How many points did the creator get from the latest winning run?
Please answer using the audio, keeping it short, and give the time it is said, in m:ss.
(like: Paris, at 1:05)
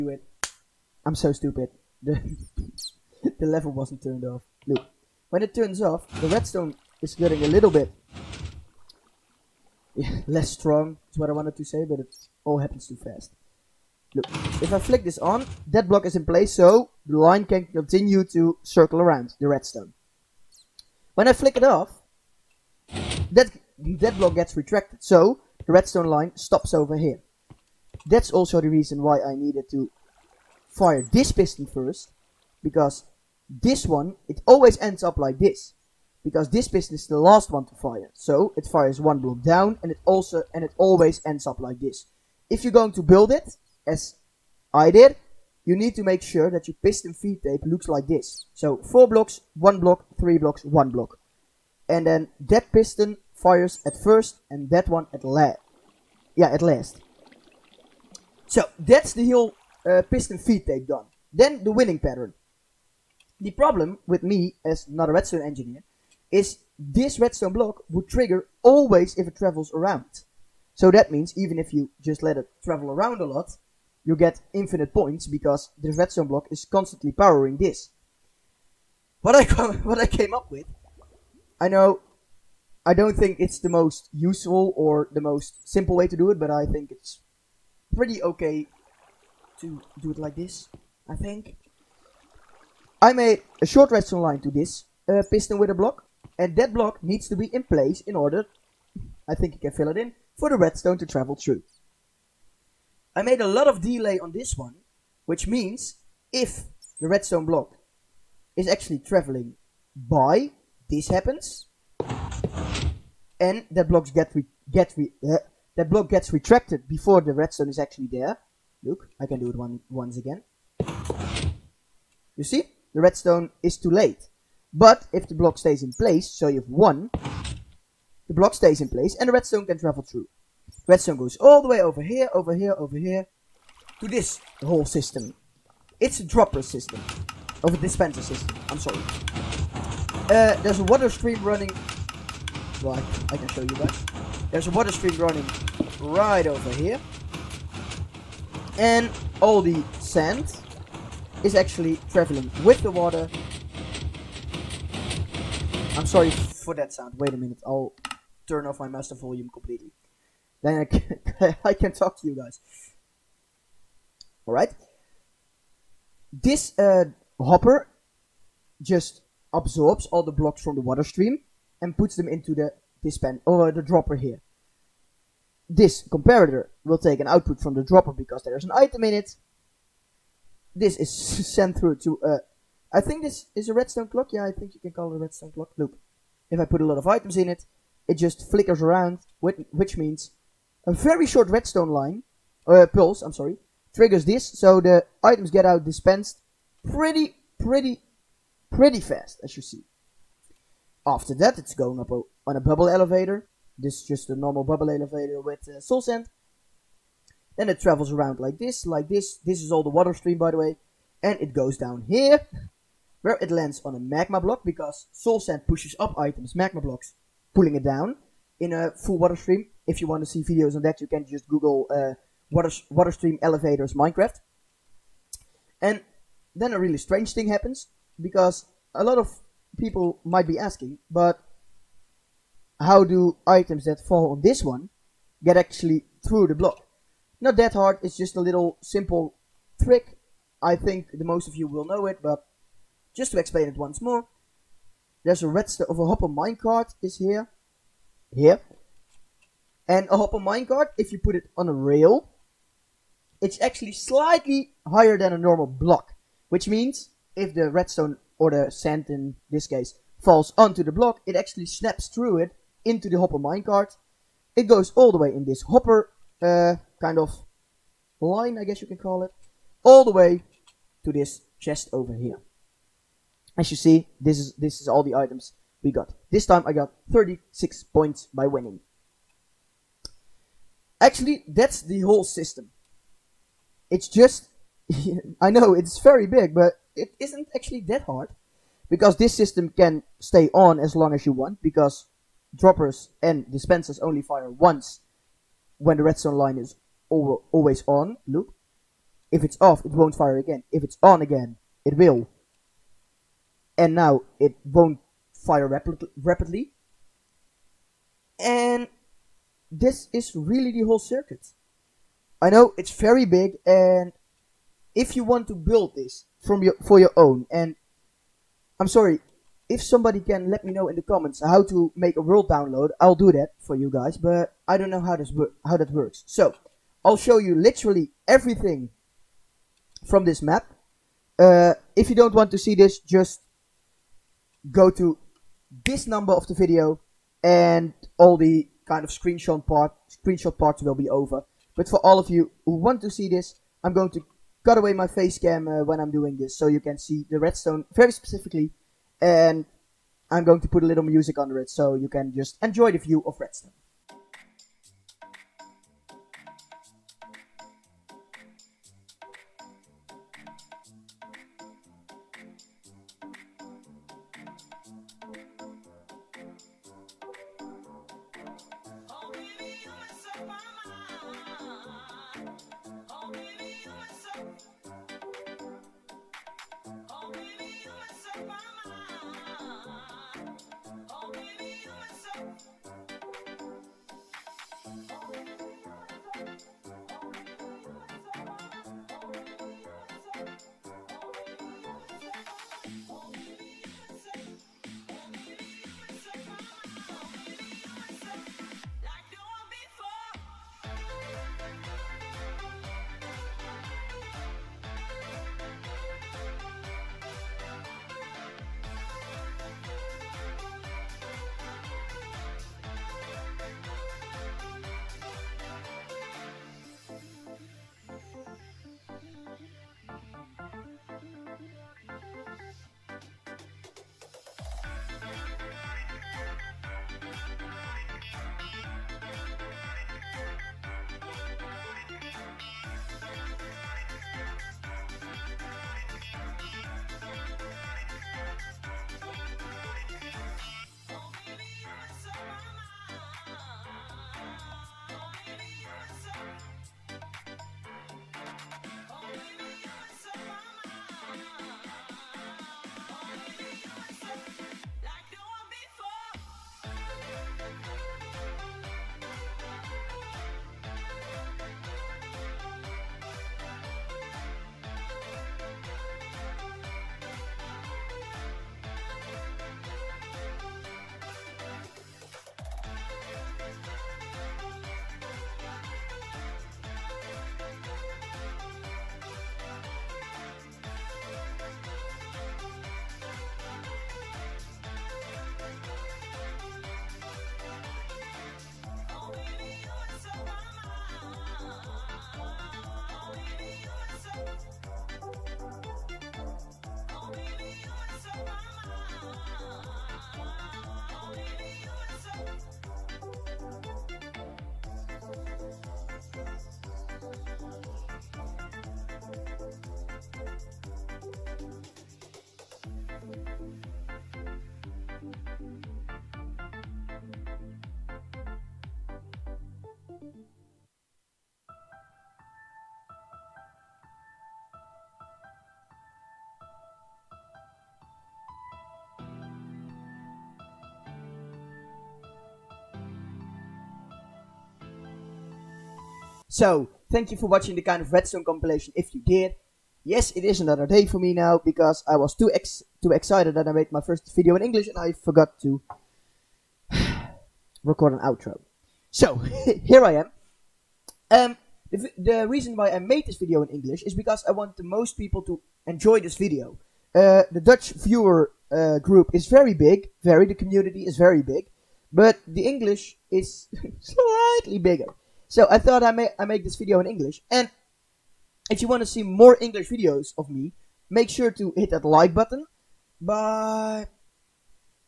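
36, at 4:37.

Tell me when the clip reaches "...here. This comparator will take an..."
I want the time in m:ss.
2:54.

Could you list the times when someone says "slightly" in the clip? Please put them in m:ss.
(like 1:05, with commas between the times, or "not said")
4:13, 9:24.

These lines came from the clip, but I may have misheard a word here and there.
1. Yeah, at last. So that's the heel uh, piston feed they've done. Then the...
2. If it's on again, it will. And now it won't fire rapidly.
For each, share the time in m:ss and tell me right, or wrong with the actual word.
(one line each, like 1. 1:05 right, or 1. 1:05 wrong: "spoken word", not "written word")
1. 0:56 right
2. 5:00 right.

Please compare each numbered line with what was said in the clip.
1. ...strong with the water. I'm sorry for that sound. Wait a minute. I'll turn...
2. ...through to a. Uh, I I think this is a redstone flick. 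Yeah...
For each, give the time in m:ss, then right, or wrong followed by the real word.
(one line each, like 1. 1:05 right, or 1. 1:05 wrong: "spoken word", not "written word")
1. 2:32 wrong: "traveling", not "strong"
2. 3:01 wrong: "clock", not "flick".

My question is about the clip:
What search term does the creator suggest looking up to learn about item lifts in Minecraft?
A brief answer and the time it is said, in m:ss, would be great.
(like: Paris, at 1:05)
Water stream elevators, at 3:42.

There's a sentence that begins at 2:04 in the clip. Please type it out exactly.
But if the block stays in place, so you have one, the block stays in place and the redstone can travel through.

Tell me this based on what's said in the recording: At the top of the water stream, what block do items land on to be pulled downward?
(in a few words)
Magma block.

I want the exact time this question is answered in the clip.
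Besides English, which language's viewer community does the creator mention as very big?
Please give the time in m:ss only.
9:17.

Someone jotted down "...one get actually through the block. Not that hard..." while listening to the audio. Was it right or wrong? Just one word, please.
right.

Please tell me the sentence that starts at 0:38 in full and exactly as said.
So it fires one block down and it also and it always ends up like this.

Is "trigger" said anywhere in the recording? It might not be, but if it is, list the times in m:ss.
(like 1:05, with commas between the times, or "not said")
1:08, 3:13.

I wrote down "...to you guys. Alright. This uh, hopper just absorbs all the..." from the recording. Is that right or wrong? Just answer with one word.
right.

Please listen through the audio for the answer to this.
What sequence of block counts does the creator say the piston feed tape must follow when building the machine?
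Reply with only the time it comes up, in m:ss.
0:48.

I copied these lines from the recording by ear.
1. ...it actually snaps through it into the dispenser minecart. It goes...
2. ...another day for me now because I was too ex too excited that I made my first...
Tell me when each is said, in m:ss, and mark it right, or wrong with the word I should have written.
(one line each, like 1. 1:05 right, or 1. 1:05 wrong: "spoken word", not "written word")
1. 4:21 wrong: "hopper", not "dispenser"
2. 9:00 right.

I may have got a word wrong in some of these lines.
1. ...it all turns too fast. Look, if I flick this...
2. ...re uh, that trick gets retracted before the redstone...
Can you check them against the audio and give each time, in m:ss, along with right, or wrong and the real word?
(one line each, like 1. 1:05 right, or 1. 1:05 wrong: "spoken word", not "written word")
1. 0:12 wrong: "happens", not "turns"
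2. 1:54 wrong: "block", not "trick".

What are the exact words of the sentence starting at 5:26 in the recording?
So, I'll show you literally everything from this map.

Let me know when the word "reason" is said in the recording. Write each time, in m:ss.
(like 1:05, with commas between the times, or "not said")
0:28, 9:12.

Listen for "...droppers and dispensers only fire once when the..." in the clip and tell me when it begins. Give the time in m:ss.
4:52.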